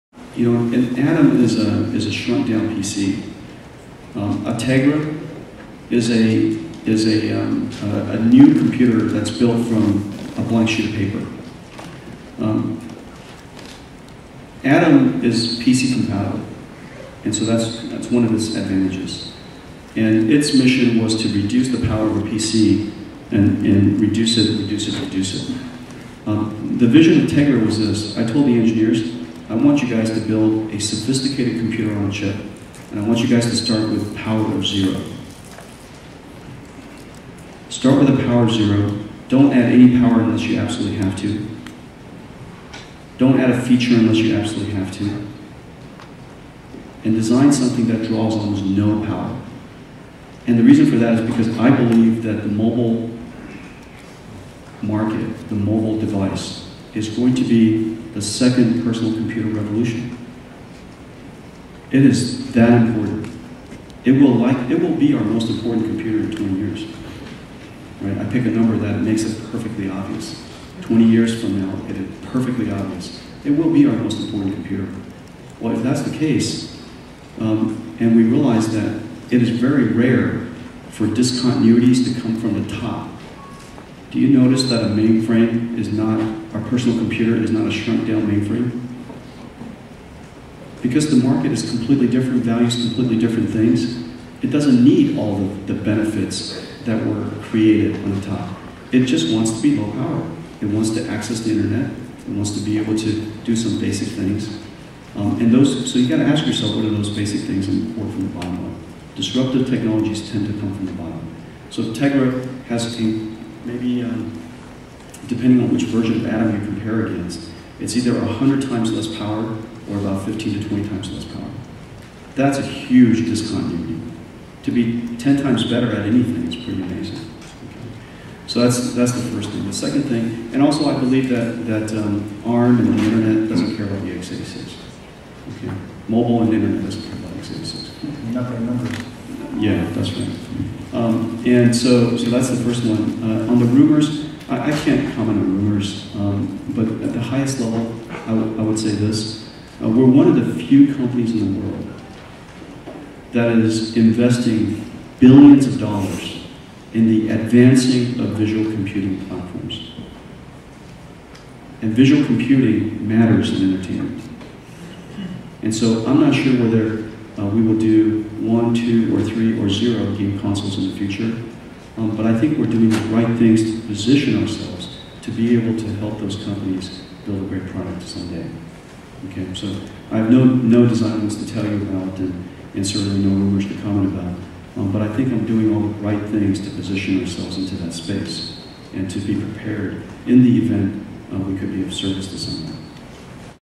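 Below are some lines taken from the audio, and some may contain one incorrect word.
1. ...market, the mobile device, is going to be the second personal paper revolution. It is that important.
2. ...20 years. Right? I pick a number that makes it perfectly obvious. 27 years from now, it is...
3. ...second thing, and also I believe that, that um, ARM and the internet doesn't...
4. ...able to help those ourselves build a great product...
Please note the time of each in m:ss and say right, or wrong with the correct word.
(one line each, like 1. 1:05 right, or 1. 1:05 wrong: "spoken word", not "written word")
1. 0:54 wrong: "computer", not "paper"
2. 1:06 wrong: "20", not "27"
3. 2:09 right
4. 2:55 wrong: "companies", not "ourselves".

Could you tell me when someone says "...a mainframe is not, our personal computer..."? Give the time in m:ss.
1:24.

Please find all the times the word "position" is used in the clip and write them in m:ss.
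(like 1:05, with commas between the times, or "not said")
2:53, 3:06.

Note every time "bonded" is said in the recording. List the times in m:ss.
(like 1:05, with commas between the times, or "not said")
not said.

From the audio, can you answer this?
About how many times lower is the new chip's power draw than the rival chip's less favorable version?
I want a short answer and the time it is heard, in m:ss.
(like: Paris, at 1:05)
15 to 20, at 2:00.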